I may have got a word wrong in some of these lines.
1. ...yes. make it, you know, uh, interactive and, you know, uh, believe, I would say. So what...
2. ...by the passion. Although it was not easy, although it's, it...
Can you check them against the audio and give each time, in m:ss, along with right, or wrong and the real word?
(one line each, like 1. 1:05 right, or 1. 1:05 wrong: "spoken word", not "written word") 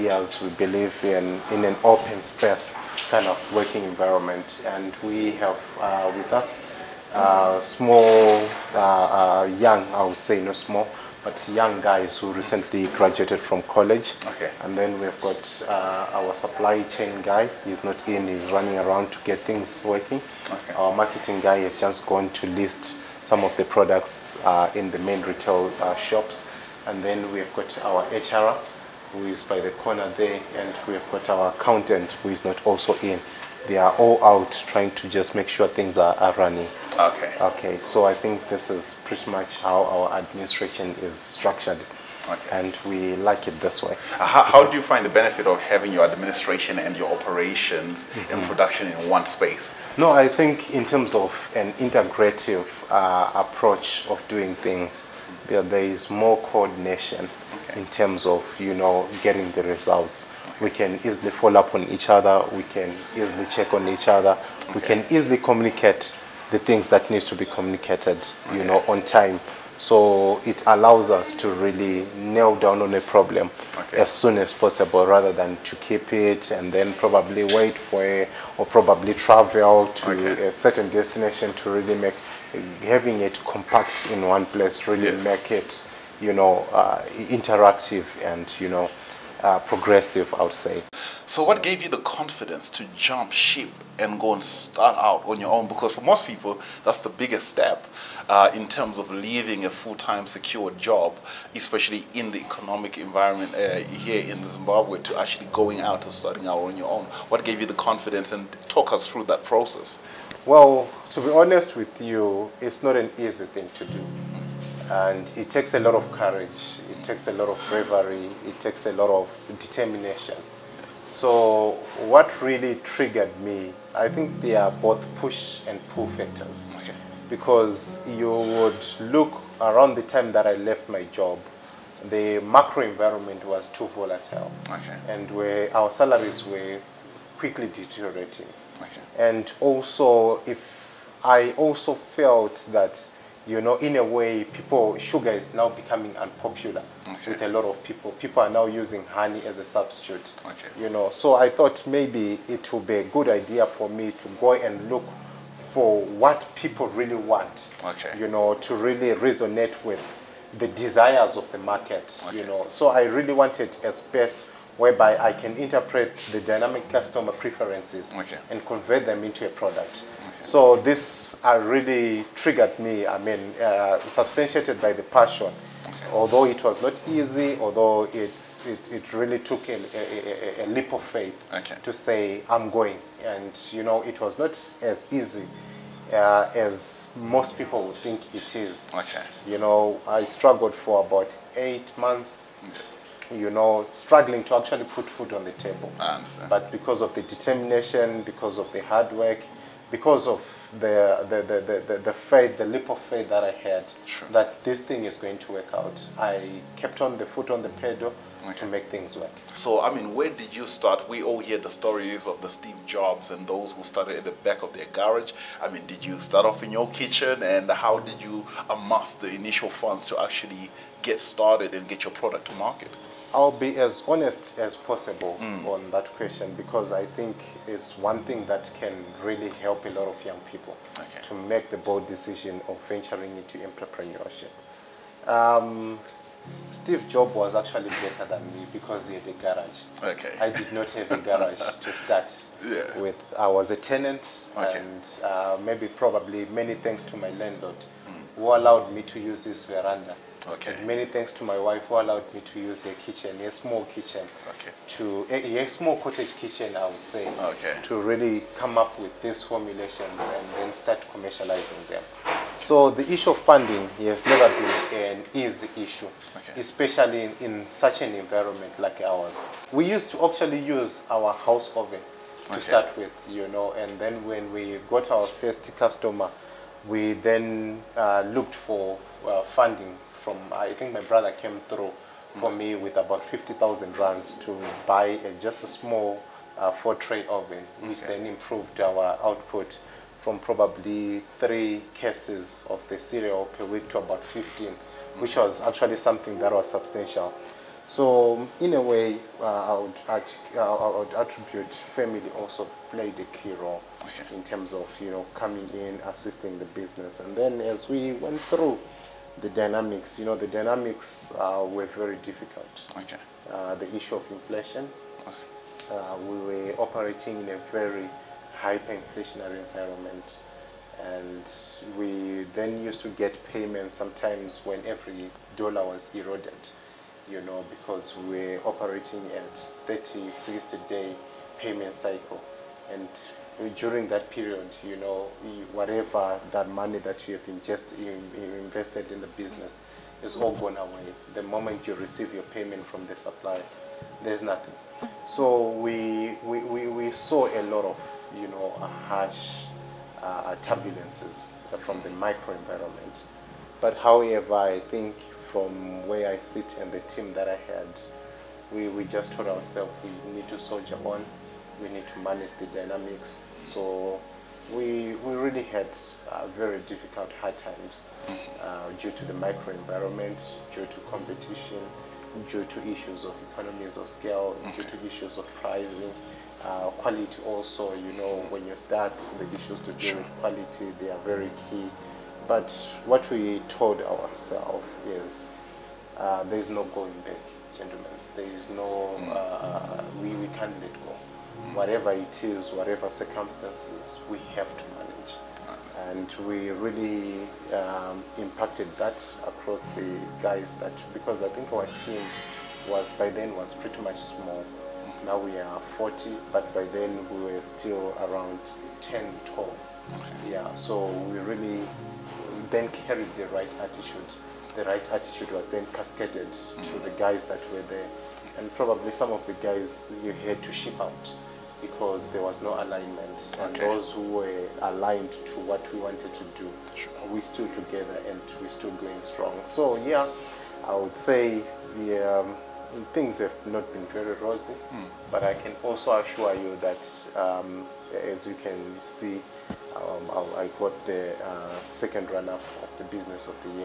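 1. 1:25 wrong: "progressive", not "believe"
2. 2:54 right.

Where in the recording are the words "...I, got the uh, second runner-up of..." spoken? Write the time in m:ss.
7:20.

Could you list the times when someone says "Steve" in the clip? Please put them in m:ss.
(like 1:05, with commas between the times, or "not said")
3:32, 3:56.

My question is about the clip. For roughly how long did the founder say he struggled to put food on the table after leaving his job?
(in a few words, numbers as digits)
8 months.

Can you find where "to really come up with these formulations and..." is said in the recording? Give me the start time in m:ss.
4:17.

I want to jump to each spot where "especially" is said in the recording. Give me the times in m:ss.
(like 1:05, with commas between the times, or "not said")
1:41, 4:26.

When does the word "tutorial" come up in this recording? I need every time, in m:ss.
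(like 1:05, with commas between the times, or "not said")
not said.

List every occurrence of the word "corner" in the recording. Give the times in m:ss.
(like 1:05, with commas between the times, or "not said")
0:29.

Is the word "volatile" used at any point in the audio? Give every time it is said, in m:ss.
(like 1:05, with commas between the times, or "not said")
2:13.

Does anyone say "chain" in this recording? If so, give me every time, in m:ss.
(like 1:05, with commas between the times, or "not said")
0:16.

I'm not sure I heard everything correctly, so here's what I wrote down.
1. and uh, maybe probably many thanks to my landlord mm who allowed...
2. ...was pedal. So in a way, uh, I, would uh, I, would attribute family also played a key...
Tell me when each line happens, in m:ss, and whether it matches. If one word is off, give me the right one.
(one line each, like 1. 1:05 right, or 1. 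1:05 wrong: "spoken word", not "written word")
1. 4:04 right
2. 4:56 wrong: "substantial", not "pedal".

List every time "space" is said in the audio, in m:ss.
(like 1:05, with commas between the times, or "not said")
0:02, 0:49, 2:43.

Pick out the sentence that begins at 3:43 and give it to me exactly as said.
I'll be as honest as possible mm.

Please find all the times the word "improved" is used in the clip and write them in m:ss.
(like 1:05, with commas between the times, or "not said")
4:48.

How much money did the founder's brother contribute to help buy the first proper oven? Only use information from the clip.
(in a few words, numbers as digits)
50,000 rands.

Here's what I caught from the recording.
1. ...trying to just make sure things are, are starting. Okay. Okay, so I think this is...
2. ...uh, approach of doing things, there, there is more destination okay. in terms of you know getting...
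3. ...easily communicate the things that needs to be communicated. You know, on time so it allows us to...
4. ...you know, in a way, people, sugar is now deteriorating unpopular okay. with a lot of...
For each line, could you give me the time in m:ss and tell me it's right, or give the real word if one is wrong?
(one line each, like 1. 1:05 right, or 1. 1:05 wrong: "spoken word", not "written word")
1. 0:34 wrong: "running", not "starting"
2. 0:52 wrong: "coordination", not "destination"
3. 1:05 right
4. 2:23 wrong: "becoming", not "deteriorating".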